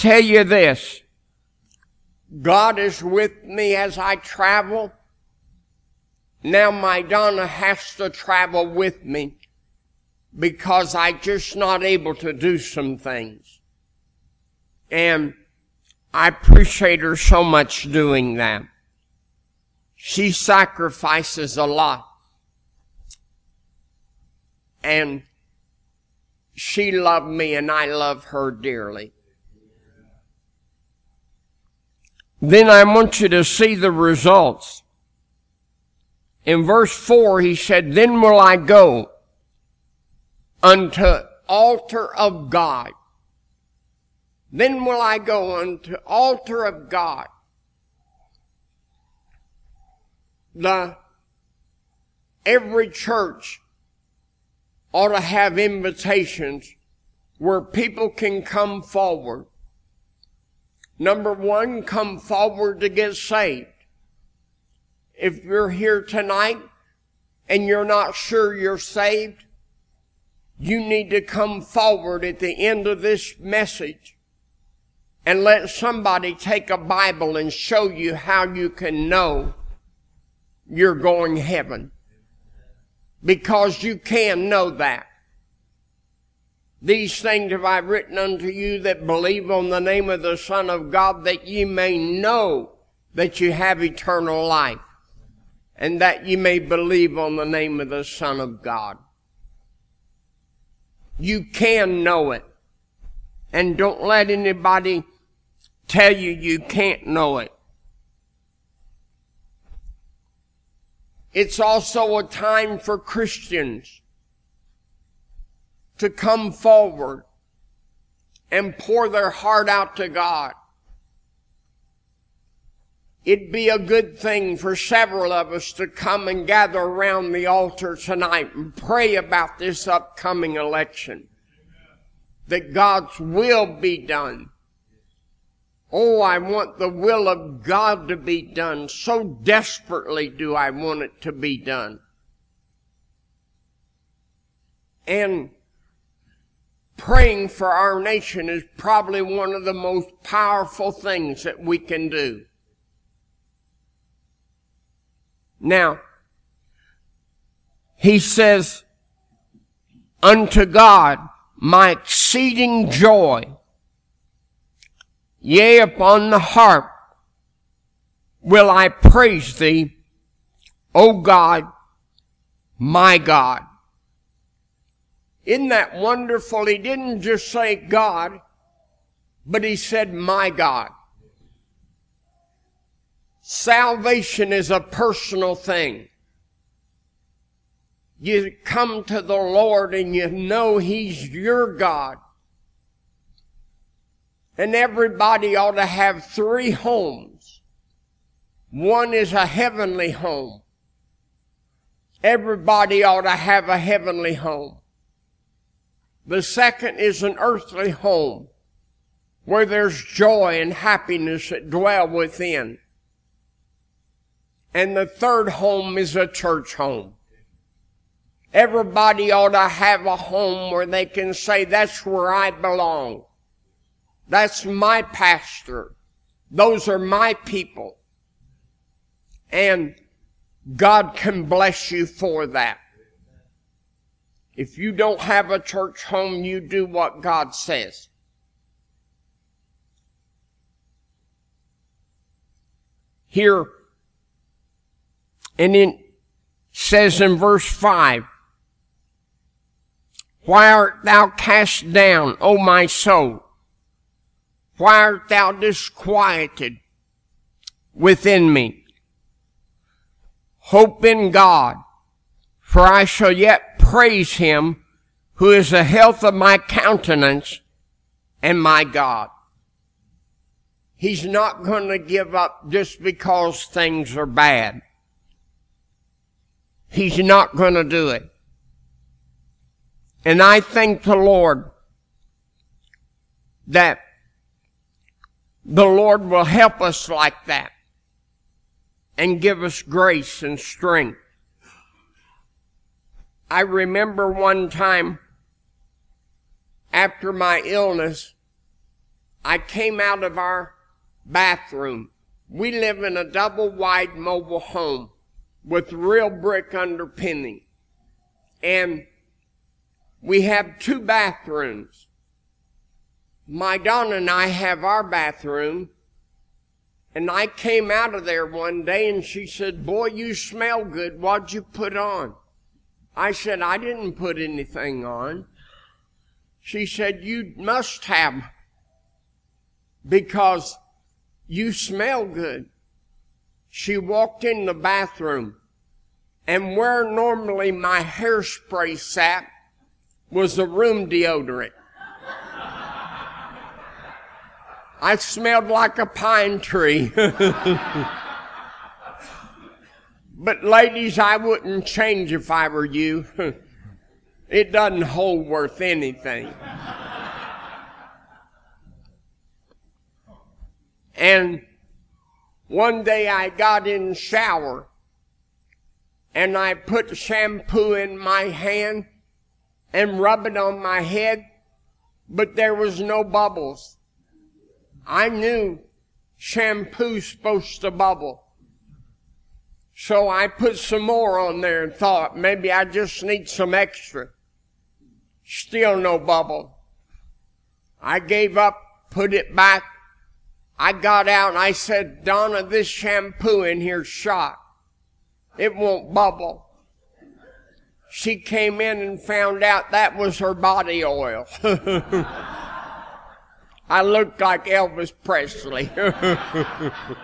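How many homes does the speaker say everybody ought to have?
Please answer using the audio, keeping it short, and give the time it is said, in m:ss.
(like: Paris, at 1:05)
3, at 3:16.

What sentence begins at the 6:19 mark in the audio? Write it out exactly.
So I put some more on there and thought maybe I just need some extra.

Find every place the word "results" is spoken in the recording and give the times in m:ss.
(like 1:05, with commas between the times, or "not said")
0:33.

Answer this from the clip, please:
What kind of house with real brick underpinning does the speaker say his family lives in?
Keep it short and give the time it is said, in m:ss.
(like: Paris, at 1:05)
Double wide mobile home, at 5:03.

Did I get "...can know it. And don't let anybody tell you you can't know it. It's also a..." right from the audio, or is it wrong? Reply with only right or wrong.
right.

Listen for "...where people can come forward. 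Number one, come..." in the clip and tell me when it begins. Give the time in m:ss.
0:57.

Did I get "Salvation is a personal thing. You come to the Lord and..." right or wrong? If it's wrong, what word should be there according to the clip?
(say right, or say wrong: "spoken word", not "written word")
right.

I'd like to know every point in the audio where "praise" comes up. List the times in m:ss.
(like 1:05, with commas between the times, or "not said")
2:48, 4:23.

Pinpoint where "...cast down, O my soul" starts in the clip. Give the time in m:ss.
4:11.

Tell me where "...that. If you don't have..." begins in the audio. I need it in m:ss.
3:52.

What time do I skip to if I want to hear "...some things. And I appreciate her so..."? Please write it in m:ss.
0:12.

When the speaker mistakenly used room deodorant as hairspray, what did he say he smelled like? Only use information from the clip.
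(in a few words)
A pine tree.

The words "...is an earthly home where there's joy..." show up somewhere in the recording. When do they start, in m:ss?
3:26.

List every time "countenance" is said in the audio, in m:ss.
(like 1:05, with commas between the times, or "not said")
4:26.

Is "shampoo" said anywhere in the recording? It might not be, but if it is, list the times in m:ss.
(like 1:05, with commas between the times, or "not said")
6:07, 6:16, 6:32.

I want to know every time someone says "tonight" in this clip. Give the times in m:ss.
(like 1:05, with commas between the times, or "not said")
1:06, 2:07.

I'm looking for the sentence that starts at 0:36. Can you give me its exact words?
In verse 4, he said, Then will I go unto altar of God.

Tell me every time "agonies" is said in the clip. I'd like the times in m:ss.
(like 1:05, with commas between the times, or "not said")
not said.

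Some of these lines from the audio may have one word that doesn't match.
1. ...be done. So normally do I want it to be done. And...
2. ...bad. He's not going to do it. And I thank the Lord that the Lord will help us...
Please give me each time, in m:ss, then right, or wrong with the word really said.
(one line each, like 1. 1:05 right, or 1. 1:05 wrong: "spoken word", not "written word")
1. 2:18 wrong: "desperately", not "normally"
2. 4:34 right.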